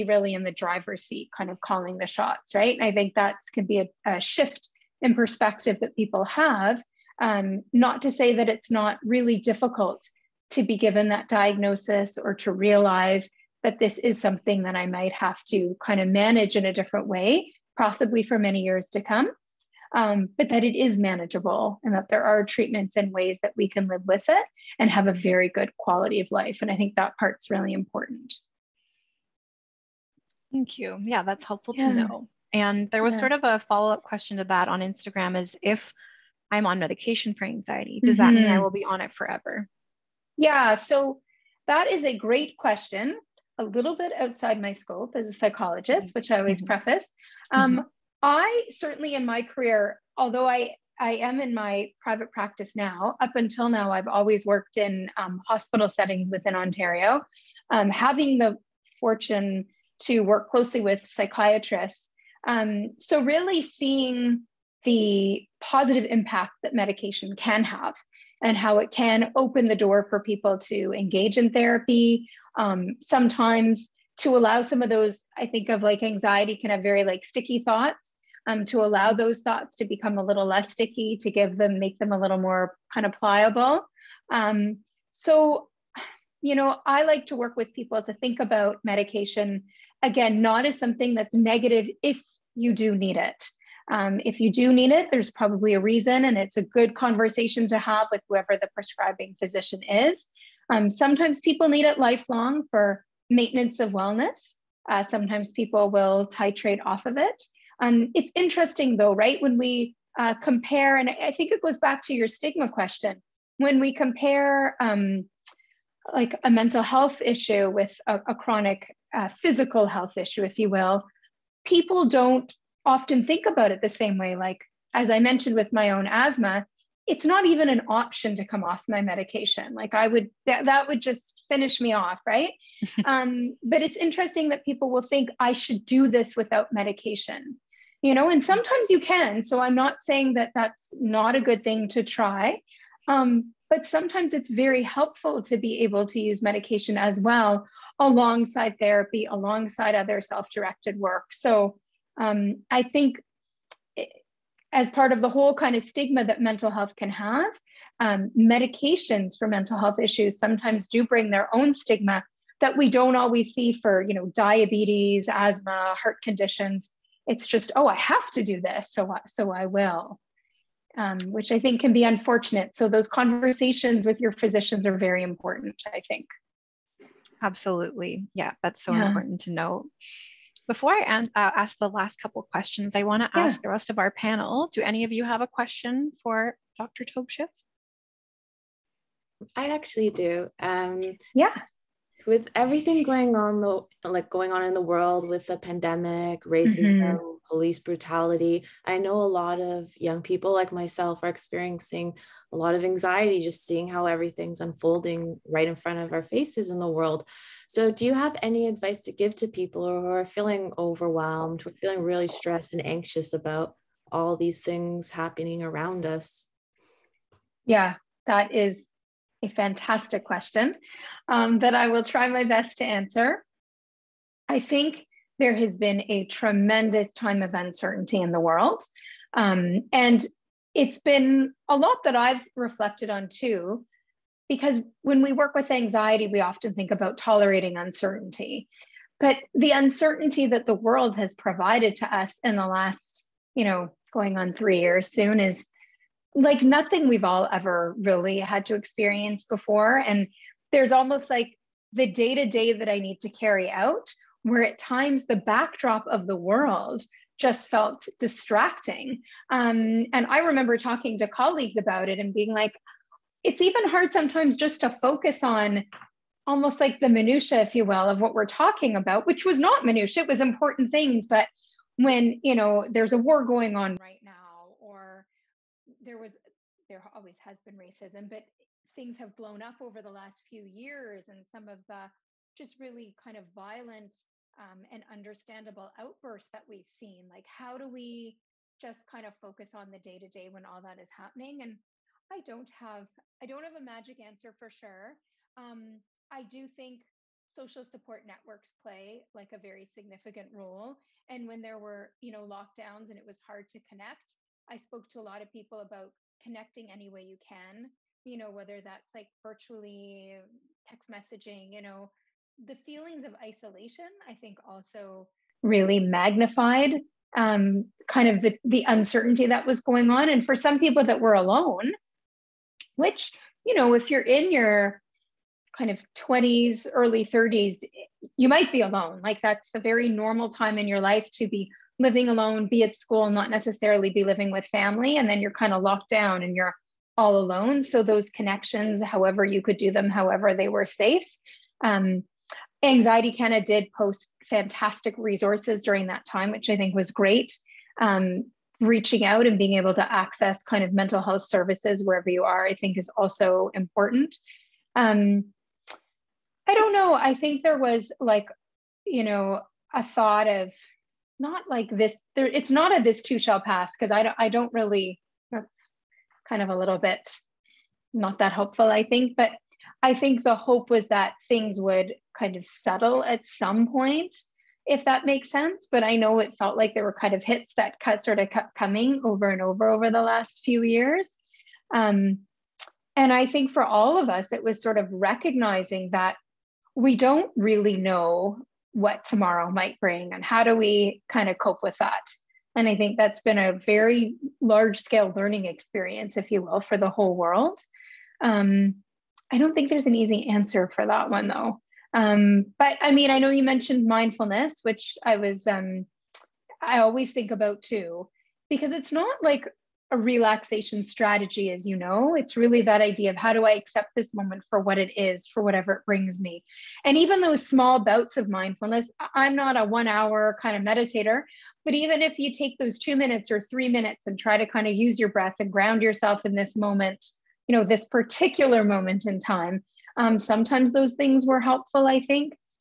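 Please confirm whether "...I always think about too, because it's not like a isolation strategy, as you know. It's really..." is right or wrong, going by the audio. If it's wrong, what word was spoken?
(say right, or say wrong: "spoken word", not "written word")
wrong: "relaxation", not "isolation".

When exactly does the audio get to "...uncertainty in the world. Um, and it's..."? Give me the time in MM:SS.
03:47.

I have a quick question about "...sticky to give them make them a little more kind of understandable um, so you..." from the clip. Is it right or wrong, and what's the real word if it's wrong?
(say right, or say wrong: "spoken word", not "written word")
wrong: "pliable", not "understandable".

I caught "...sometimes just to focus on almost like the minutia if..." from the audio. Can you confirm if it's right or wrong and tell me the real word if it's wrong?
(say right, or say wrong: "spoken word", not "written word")
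right.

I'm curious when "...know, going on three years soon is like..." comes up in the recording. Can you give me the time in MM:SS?
04:03.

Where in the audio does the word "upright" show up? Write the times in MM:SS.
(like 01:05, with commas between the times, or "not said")
not said.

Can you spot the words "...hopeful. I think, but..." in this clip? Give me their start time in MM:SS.
06:08.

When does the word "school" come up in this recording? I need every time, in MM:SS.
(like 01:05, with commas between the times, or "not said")
05:32.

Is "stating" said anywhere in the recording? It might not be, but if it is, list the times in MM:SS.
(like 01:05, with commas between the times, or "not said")
not said.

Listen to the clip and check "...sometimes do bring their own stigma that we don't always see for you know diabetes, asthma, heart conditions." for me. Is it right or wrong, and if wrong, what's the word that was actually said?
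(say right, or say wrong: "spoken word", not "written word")
right.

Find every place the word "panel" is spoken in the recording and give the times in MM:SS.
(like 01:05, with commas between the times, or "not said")
03:04.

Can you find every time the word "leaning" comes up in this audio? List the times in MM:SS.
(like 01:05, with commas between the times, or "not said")
not said.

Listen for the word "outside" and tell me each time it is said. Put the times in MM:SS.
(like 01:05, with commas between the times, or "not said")
00:44.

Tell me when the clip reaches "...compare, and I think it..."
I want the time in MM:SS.
01:50.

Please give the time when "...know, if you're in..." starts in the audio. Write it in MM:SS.
05:23.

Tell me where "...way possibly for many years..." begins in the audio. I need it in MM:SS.
00:17.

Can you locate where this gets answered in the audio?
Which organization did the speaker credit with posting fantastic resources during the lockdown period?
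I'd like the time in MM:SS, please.
05:42.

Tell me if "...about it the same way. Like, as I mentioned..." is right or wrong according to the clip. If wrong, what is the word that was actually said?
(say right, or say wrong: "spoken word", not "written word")
right.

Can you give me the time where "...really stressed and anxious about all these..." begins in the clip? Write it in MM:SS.
03:32.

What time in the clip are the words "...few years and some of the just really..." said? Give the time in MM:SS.
04:40.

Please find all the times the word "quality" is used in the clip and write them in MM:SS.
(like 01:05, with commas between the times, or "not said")
00:25.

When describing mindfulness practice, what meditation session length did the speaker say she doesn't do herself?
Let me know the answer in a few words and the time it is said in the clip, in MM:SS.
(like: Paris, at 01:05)
One hour, at 06:59.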